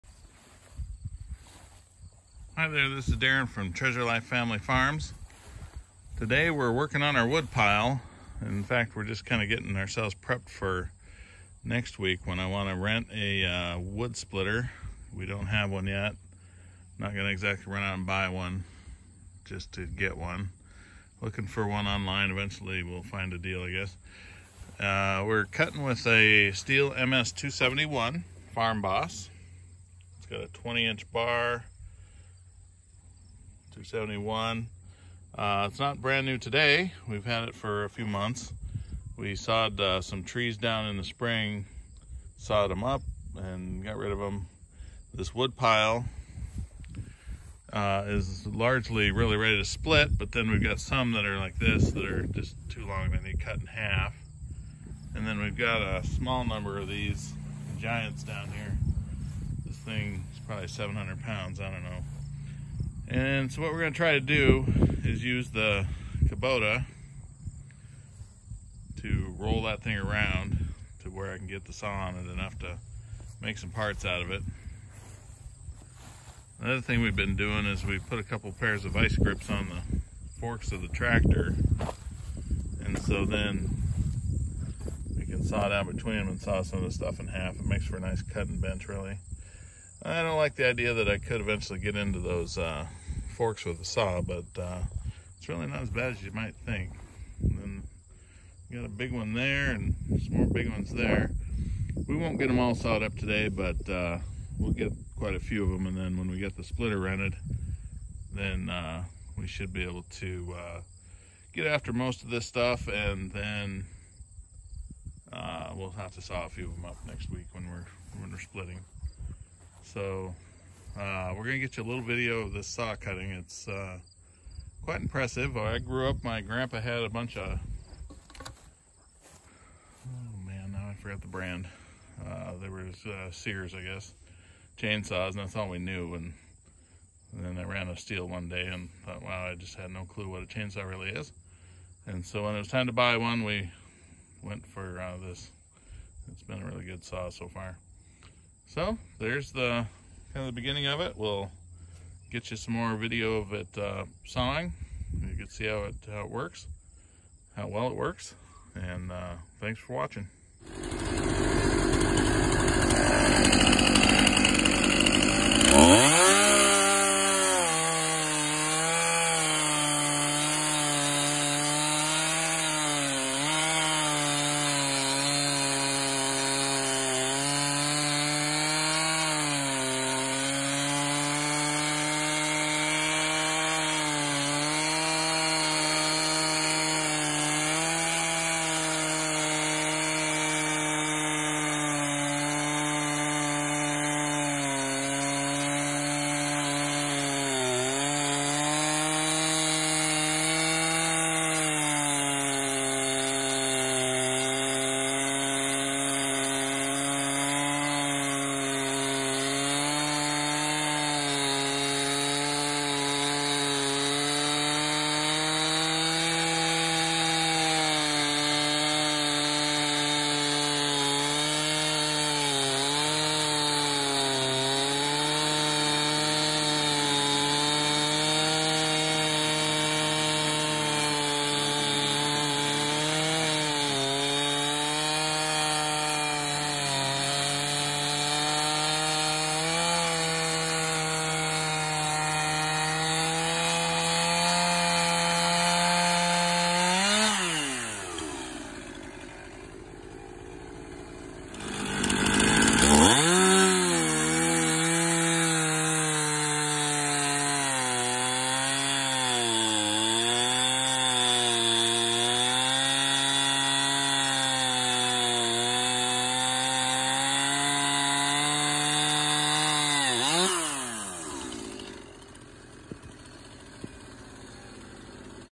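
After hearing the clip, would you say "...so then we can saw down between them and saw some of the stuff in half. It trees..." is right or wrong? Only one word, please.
wrong.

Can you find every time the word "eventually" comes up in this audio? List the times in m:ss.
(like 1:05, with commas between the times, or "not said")
0:22, 1:31.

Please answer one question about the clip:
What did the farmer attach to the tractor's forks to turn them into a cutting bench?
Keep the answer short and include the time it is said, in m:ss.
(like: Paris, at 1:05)
ice grips, at 1:18.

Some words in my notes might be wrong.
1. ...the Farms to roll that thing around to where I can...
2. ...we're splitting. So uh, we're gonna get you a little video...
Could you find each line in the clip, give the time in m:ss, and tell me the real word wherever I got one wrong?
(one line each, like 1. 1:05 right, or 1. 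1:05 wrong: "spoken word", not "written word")
1. 1:05 wrong: "Kubota", not "Farms"
2. 1:58 right.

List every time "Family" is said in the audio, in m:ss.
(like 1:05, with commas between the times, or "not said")
0:04.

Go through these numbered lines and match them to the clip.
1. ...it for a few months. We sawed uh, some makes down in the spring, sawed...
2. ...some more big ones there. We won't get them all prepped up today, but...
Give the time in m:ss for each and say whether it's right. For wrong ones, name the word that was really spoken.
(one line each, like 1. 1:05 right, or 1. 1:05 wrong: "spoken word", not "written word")
1. 0:37 wrong: "trees", not "makes"
2. 1:40 wrong: "sawed", not "prepped".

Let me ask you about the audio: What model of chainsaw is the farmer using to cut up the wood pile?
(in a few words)
Stihl MS-271 Farm Boss.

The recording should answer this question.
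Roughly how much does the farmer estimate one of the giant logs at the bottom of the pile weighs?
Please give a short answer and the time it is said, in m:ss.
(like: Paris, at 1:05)
700 pounds, at 1:00.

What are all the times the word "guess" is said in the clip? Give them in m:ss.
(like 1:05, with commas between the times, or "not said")
0:23, 2:13.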